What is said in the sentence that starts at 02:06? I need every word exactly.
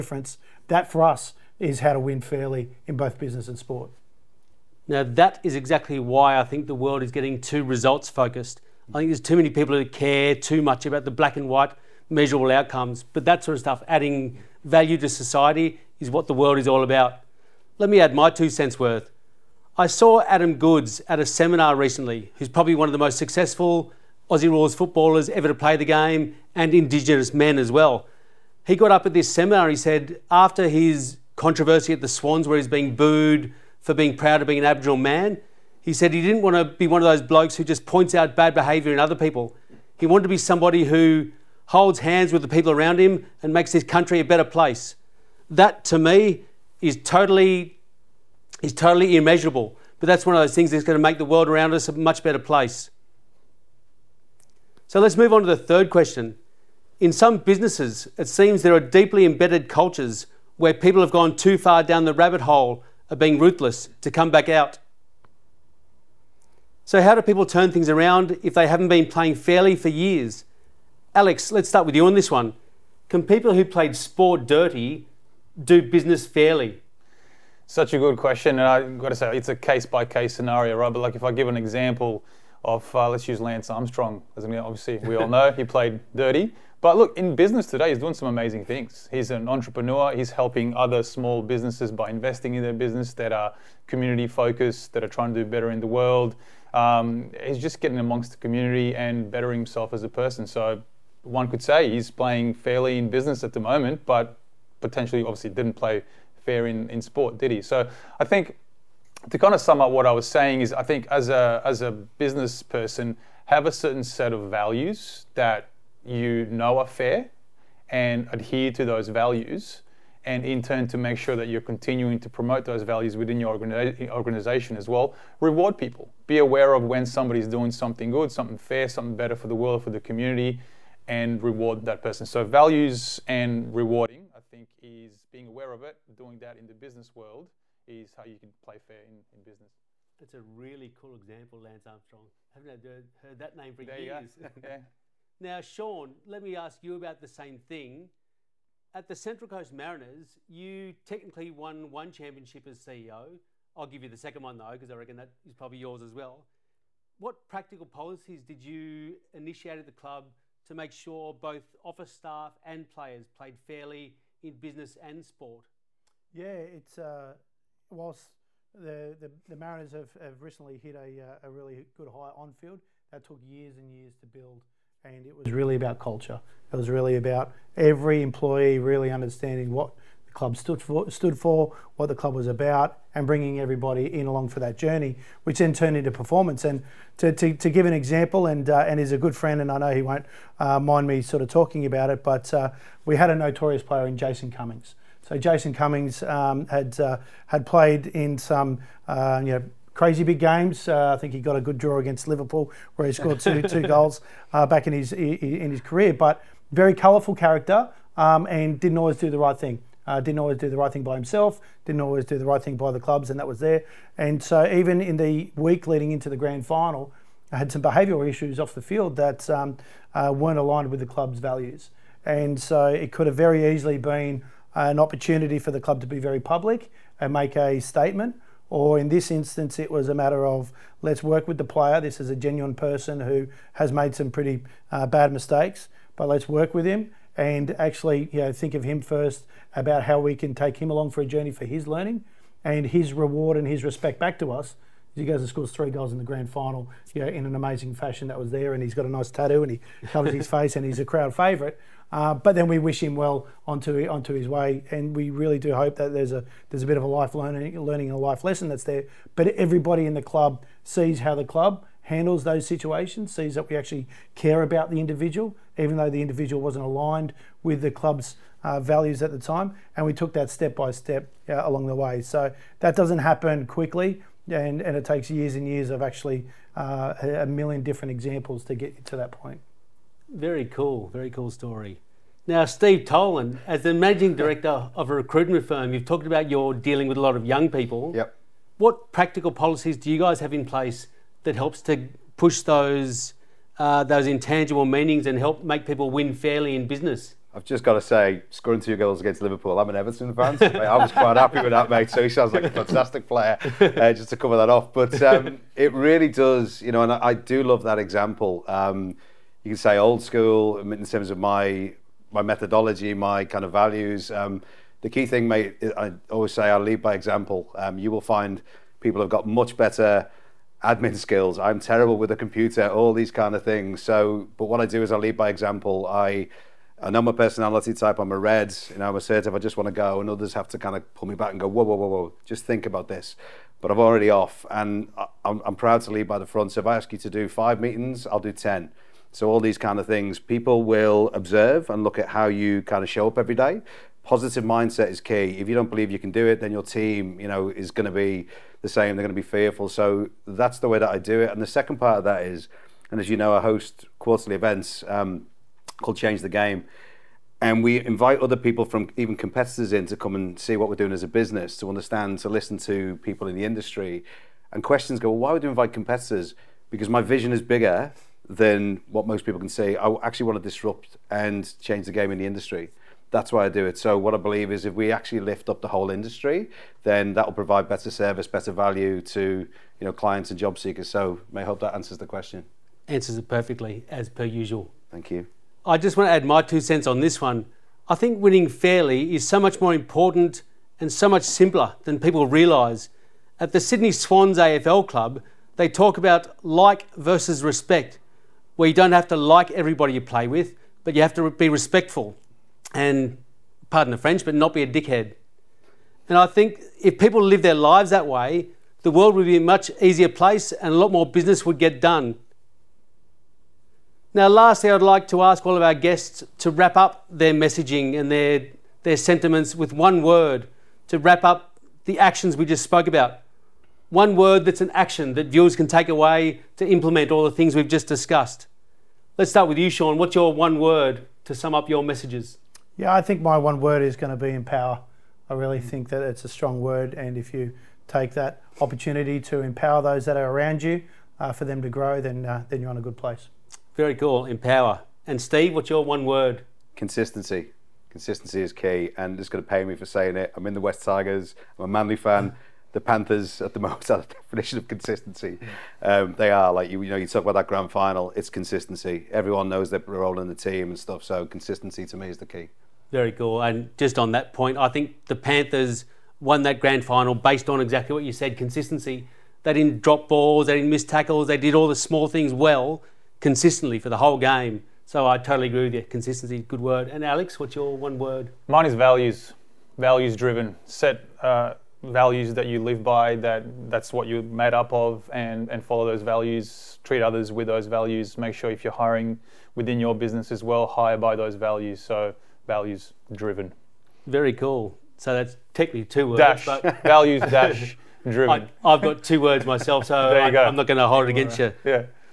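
Be aware of when somebody's doing something good, something fair, something better for the world, for the community, and reward that person.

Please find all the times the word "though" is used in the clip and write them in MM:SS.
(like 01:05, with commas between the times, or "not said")
02:34, 04:25.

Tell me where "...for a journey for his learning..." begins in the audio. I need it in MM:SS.
04:01.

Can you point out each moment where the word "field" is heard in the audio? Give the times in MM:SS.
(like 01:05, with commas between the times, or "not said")
02:52, 03:38.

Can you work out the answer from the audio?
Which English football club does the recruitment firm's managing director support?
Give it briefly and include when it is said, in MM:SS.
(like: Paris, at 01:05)
Everton, at 04:59.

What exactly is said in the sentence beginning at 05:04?
But um, it really does, you know, and I, I do love that example.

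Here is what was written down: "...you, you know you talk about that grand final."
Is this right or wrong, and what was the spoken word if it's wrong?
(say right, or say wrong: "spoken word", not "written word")
right.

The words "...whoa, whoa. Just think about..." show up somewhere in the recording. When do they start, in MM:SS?
05:31.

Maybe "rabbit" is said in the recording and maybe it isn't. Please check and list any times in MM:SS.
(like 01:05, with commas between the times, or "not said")
01:02.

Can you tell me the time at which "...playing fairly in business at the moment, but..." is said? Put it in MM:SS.
01:42.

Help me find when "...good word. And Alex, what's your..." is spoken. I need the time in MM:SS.
07:56.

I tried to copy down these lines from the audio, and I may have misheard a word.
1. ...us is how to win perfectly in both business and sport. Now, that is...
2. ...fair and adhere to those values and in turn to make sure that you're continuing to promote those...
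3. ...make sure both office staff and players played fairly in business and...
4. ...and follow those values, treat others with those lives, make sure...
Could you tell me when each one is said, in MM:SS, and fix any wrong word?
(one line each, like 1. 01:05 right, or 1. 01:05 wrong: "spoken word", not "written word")
1. 00:01 wrong: "fairly", not "perfectly"
2. 01:56 right
3. 02:40 right
4. 08:05 wrong: "values", not "lives".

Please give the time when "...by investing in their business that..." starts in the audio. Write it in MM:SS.
01:31.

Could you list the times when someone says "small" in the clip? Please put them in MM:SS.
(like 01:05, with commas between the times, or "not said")
01:31, 07:51.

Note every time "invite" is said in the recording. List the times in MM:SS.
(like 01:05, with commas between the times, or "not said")
05:58, 06:05.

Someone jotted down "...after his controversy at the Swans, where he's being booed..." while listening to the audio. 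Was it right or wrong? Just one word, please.
right.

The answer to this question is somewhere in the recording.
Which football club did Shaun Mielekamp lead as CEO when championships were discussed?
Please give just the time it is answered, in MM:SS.
02:29.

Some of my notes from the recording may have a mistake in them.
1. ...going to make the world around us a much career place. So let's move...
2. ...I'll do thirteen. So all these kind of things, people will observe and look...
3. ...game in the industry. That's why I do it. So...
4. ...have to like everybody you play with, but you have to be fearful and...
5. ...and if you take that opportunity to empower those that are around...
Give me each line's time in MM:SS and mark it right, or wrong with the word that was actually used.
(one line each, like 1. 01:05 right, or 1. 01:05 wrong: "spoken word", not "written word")
1. 00:50 wrong: "better", not "career"
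2. 05:38 wrong: "ten", not "thirteen"
3. 06:12 right
4. 06:39 wrong: "respectful", not "fearful"
5. 07:17 right.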